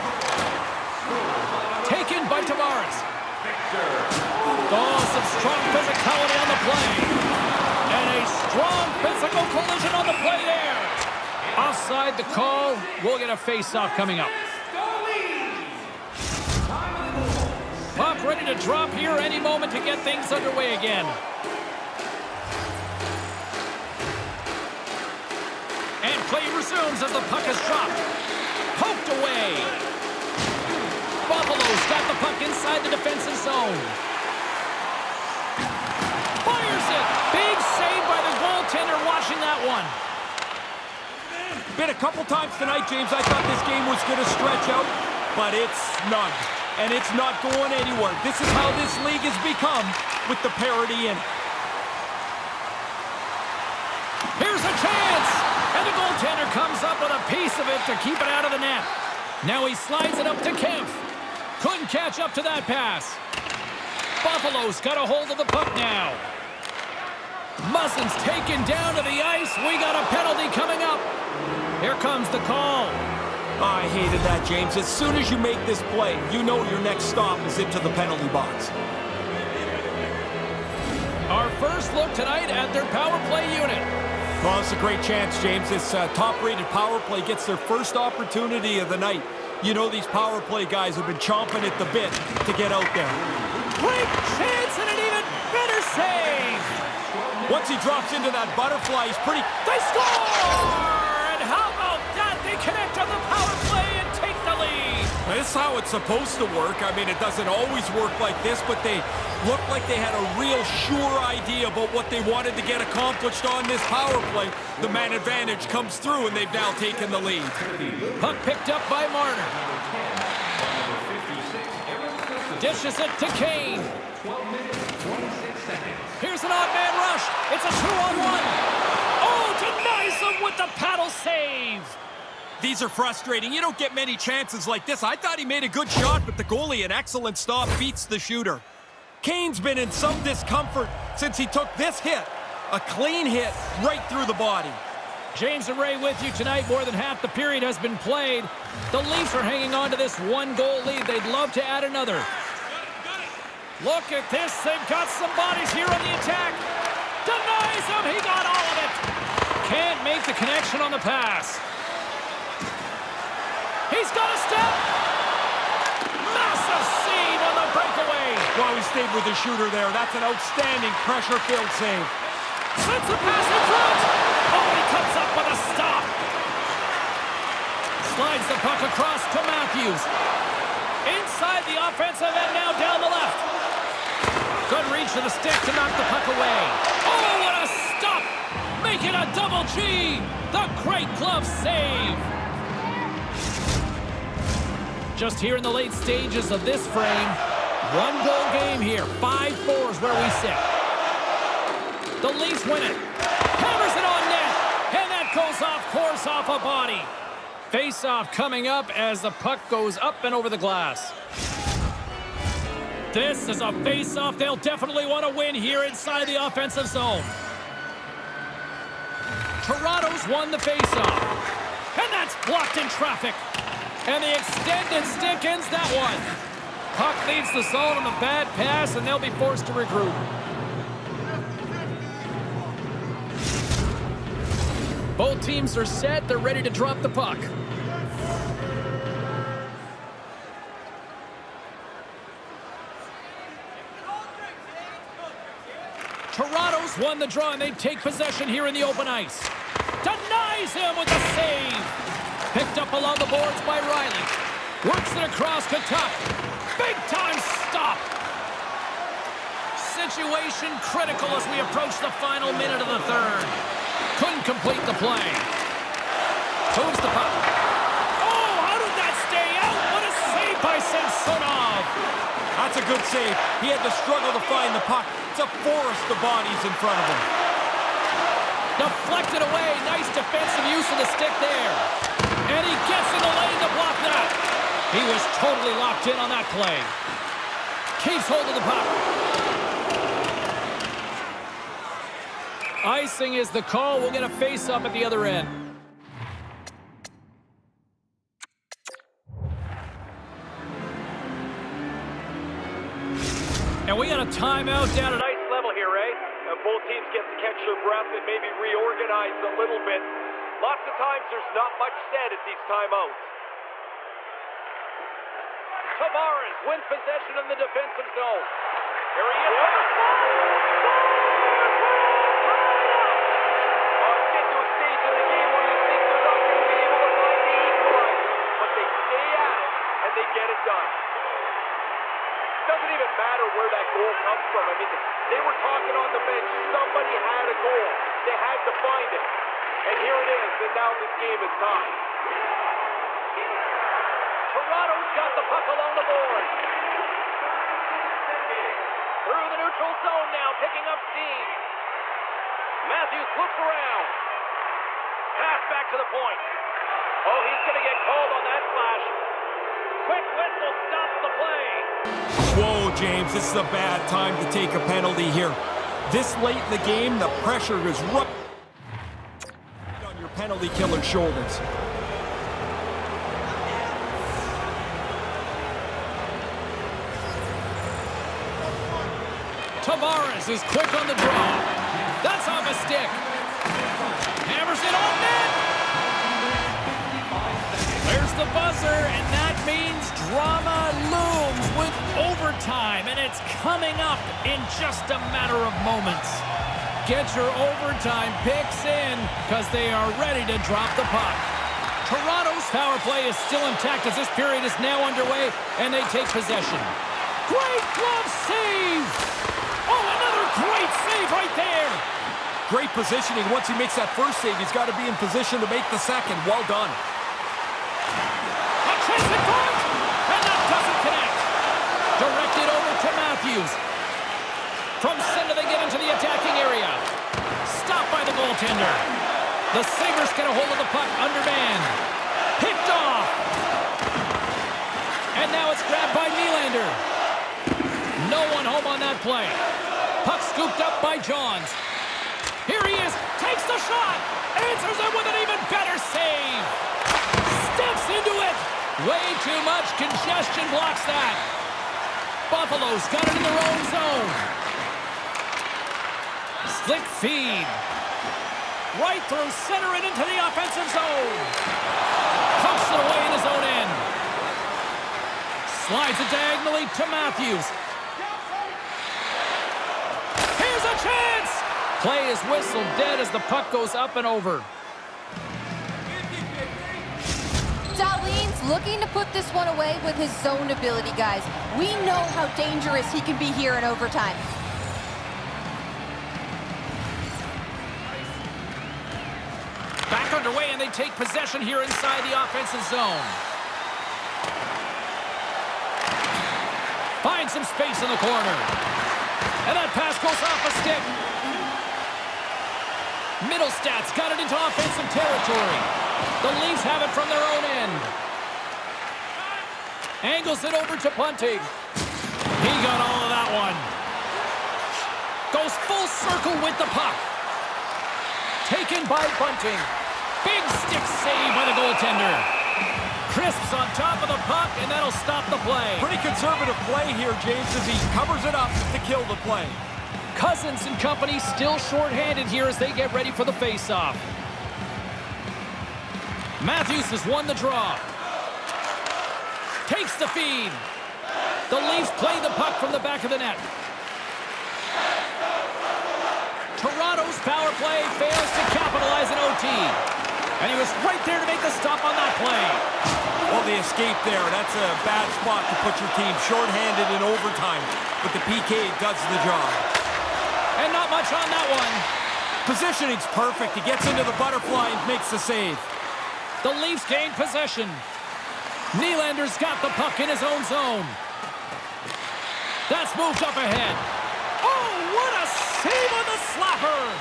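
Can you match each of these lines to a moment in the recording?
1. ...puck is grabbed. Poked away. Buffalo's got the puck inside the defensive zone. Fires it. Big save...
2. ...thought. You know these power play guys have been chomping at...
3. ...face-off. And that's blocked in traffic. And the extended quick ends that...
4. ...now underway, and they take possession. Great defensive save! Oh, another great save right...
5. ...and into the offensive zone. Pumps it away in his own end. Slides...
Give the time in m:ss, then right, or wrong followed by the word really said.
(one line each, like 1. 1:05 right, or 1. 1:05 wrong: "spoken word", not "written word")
1. 0:27 wrong: "dropped", not "grabbed"
2. 1:28 wrong: "night", not "thought"
3. 3:40 wrong: "stick", not "quick"
4. 6:44 wrong: "glove", not "defensive"
5. 7:39 right.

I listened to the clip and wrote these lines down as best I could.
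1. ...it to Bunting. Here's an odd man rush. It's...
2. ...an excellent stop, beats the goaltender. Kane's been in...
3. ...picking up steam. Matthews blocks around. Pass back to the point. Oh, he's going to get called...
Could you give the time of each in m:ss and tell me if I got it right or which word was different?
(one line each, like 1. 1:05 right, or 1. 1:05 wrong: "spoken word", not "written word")
1. 2:02 wrong: "Kane", not "Bunting"
2. 2:16 wrong: "shooter", not "goaltender"
3. 5:50 wrong: "looks", not "blocks".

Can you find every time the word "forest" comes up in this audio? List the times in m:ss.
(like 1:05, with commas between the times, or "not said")
4:35.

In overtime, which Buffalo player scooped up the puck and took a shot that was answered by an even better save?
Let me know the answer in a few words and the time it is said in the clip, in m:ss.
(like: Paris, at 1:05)
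Johns, at 7:21.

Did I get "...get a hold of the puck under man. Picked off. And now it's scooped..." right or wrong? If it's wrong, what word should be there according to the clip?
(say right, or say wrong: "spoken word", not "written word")
wrong: "grabbed", not "scooped".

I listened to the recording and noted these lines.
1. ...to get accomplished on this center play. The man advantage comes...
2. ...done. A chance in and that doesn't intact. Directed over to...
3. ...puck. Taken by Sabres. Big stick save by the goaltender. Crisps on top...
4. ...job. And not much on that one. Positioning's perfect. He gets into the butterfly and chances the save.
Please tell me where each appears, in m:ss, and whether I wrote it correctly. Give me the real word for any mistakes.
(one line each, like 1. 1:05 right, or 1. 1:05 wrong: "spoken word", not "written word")
1. 1:52 wrong: "power", not "center"
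2. 6:56 wrong: "connect", not "intact"
3. 8:36 wrong: "Bunting", not "Sabres"
4. 9:19 wrong: "makes", not "chances".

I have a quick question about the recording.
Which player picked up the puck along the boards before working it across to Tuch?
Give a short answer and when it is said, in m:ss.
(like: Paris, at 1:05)
Rielly, at 4:13.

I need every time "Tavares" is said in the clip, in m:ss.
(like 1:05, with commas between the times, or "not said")
0:02, 5:15, 6:19.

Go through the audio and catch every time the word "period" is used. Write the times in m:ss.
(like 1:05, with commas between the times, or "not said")
2:27, 6:44.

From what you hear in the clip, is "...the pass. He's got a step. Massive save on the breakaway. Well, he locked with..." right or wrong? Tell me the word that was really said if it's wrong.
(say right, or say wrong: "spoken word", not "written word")
wrong: "stayed", not "locked".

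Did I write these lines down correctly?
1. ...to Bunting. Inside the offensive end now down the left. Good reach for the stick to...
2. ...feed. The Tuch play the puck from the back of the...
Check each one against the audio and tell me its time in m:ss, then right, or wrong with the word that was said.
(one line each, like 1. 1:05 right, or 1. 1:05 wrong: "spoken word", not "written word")
1. 2:59 wrong: "Matthews", not "Bunting"
2. 9:00 wrong: "Leafs", not "Tuch".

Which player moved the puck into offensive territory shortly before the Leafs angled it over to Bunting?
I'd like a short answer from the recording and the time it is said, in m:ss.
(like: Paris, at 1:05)
Mittelstadt, at 8:23.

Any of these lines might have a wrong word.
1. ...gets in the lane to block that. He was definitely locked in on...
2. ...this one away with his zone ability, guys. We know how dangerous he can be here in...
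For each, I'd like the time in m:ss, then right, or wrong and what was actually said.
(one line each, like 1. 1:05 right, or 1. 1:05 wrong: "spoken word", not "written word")
1. 4:42 wrong: "totally", not "definitely"
2. 7:59 right.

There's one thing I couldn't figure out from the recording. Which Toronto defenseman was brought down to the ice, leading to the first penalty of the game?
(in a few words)
Muzzin.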